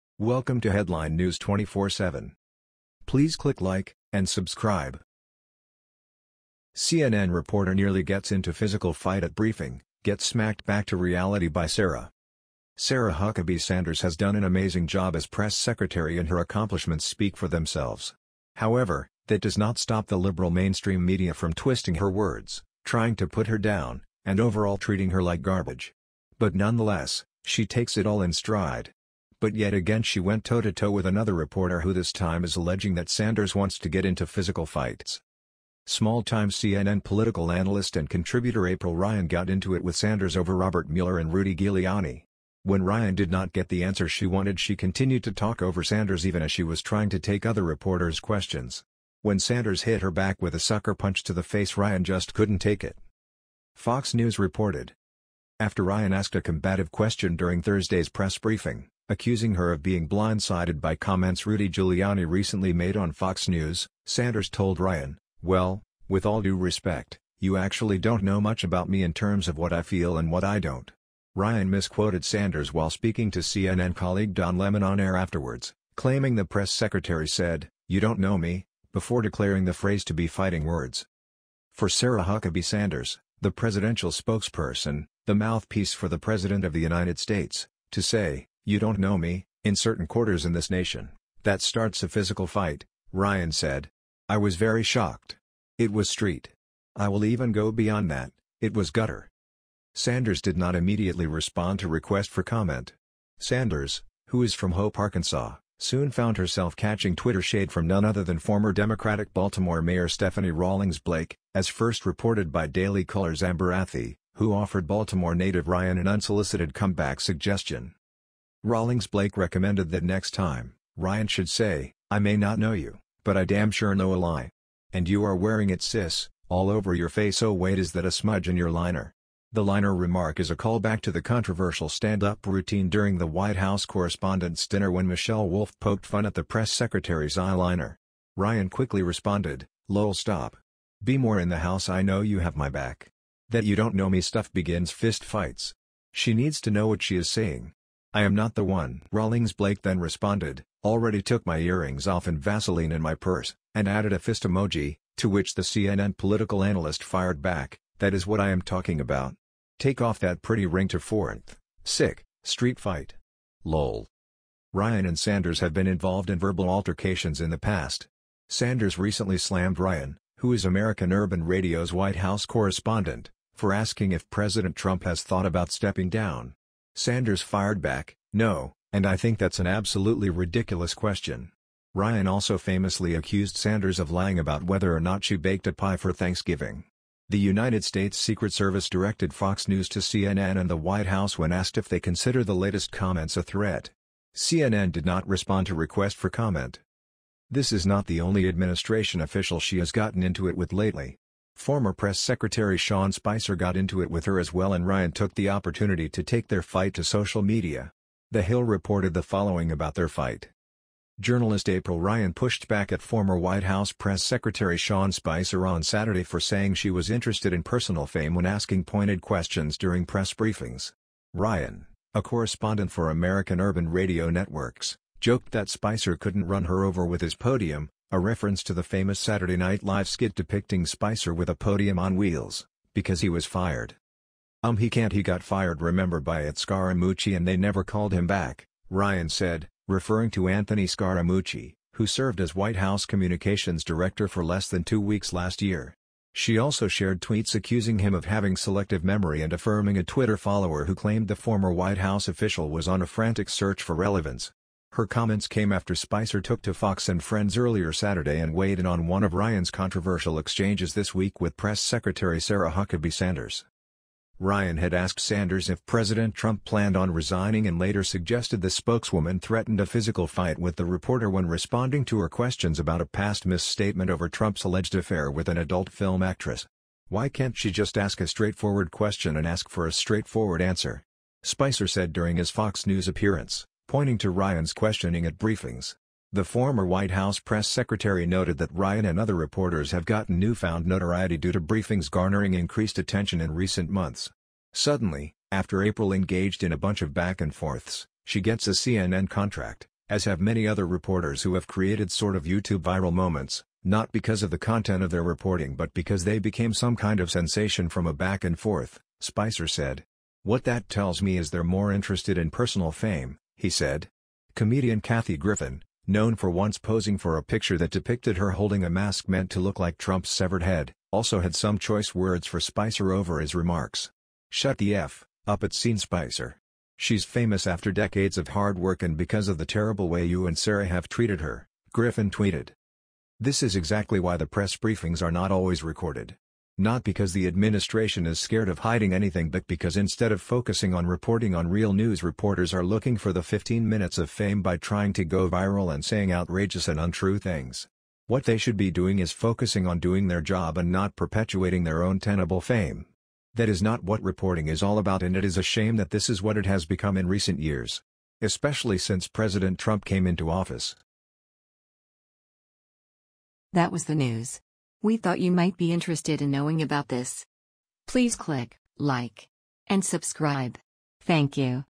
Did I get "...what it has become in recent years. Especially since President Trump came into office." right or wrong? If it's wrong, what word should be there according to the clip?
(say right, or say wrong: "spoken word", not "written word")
right.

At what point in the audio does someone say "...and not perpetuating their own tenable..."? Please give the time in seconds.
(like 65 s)
350 s.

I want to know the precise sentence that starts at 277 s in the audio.
Why can't she just ask a straightforward question and ask for a straightforward answer?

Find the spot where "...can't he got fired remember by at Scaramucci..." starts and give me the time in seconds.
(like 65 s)
234 s.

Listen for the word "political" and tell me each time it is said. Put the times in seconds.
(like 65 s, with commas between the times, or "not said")
37 s, 156 s.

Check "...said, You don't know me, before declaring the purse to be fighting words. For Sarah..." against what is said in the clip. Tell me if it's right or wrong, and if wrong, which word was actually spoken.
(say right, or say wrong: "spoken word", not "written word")
wrong: "phrase", not "purse".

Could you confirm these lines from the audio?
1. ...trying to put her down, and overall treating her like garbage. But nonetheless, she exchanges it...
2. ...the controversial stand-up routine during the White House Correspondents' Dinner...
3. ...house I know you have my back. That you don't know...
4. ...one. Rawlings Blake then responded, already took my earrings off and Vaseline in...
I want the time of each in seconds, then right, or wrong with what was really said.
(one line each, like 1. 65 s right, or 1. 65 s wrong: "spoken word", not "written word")
1. 22 s wrong: "takes", not "exchanges"
2. 131 s right
3. 141 s right
4. 148 s right.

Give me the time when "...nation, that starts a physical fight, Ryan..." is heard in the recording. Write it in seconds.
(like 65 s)
90 s.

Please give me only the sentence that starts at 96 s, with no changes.
I will even go beyond that, it was gutter.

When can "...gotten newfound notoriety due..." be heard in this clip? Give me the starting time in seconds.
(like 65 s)
290 s.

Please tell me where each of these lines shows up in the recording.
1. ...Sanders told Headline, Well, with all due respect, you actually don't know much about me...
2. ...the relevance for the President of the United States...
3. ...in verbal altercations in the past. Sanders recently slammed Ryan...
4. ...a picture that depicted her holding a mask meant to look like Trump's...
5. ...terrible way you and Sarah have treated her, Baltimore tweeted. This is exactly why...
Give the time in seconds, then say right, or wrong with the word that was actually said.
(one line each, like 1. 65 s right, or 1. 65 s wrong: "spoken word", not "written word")
1. 64 s wrong: "Ryan", not "Headline"
2. 85 s wrong: "mouthpiece", not "relevance"
3. 166 s right
4. 317 s right
5. 329 s wrong: "Griffin", not "Baltimore".